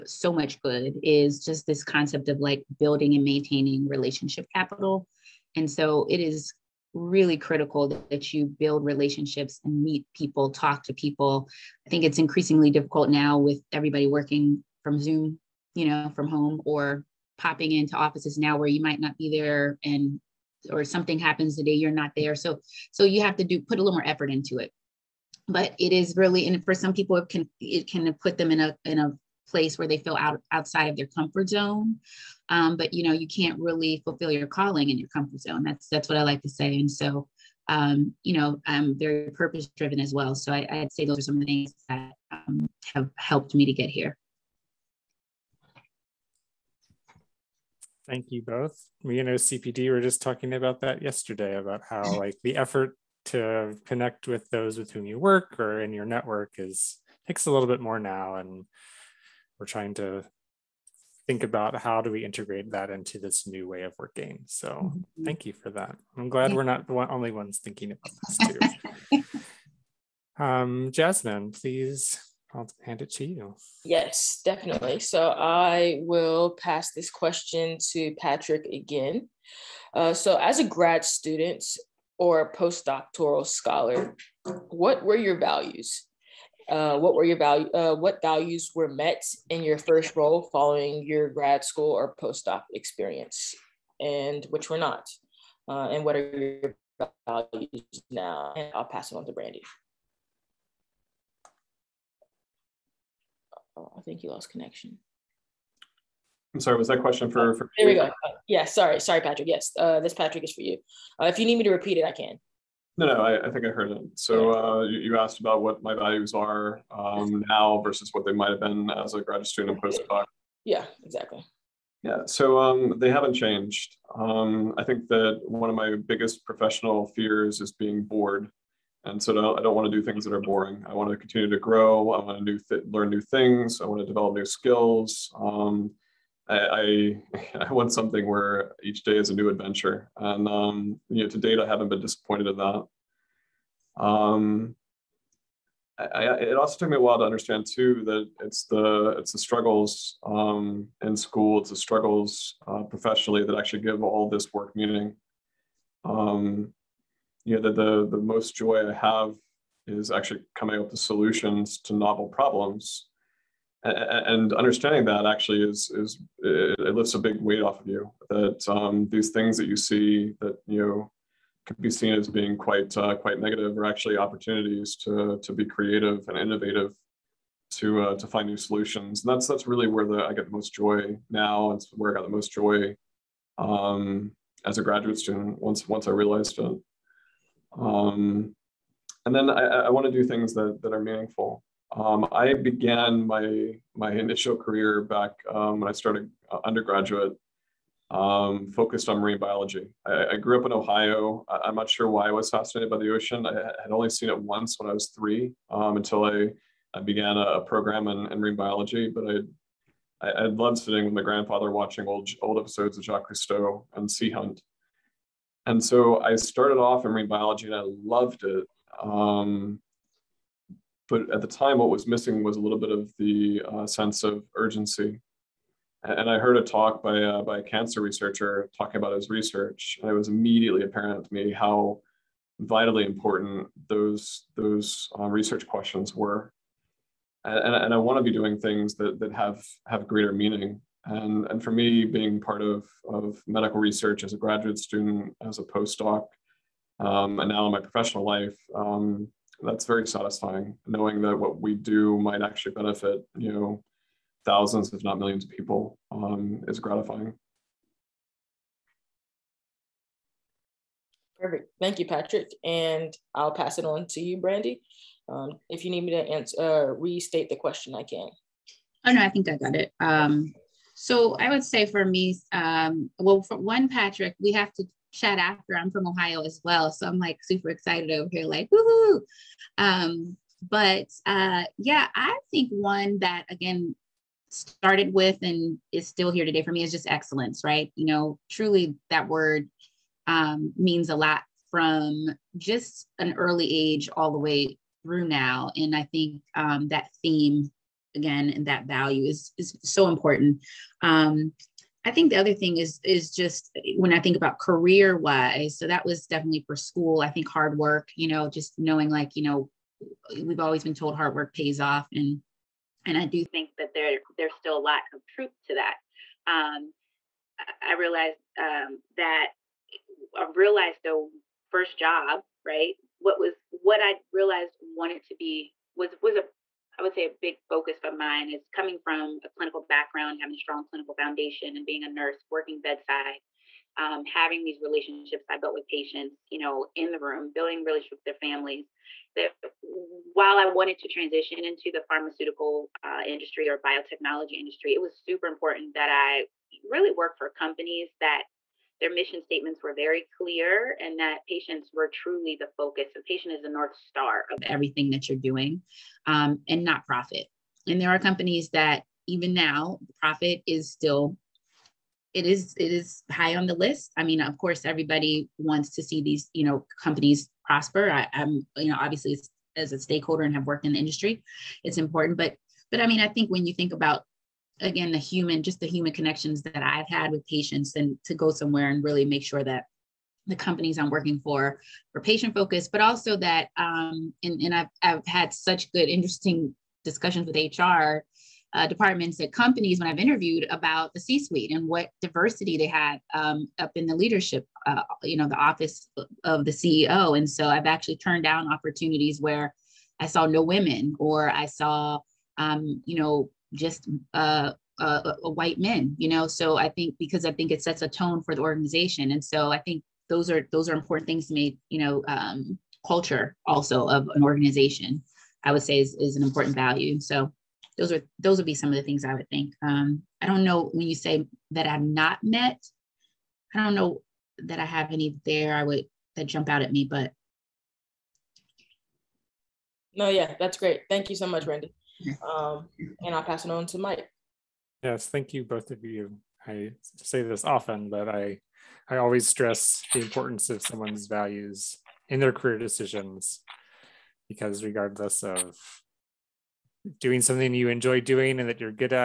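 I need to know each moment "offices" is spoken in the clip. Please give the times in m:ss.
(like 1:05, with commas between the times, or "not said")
0:17, 6:35.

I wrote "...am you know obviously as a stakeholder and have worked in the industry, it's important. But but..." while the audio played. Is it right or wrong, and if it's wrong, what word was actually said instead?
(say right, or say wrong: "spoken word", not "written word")
right.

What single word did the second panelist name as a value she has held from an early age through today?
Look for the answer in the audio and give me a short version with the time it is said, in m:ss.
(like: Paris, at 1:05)
Excellence, at 4:47.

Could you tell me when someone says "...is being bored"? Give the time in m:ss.
2:07.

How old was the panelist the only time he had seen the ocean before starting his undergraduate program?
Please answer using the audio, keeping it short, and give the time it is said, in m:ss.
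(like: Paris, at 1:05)
3, at 3:25.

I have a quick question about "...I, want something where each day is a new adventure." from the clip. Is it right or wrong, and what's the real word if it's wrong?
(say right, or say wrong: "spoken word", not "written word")
right.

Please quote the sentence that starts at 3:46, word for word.
And I heard a talk by, uh, by a cancer researcher talking about his research.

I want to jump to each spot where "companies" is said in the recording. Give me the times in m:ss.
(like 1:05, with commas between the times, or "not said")
5:47, 5:58, 6:07, 6:20, 6:29.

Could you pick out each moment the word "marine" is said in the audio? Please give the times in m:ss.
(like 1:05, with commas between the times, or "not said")
3:19, 3:28, 3:37.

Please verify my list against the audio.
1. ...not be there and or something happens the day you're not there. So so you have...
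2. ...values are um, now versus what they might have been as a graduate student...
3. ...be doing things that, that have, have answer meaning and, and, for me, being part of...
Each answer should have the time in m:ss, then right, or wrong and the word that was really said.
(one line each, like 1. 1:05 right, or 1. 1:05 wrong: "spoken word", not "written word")
1. 0:18 right
2. 1:55 right
3. 3:58 wrong: "greater", not "answer".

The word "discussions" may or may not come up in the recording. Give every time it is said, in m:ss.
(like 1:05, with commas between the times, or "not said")
6:27.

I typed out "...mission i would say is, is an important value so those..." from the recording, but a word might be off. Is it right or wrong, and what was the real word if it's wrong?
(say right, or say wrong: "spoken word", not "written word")
wrong: "organization", not "mission".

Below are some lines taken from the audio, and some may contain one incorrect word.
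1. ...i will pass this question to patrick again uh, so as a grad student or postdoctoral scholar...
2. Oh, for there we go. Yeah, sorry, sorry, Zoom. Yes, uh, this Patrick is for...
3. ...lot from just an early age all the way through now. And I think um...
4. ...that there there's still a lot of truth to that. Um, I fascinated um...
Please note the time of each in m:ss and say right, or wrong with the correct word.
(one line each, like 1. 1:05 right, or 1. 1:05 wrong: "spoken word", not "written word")
1. 1:15 right
2. 1:47 wrong: "Patrick", not "Zoom"
3. 4:51 right
4. 5:13 wrong: "realized", not "fascinated".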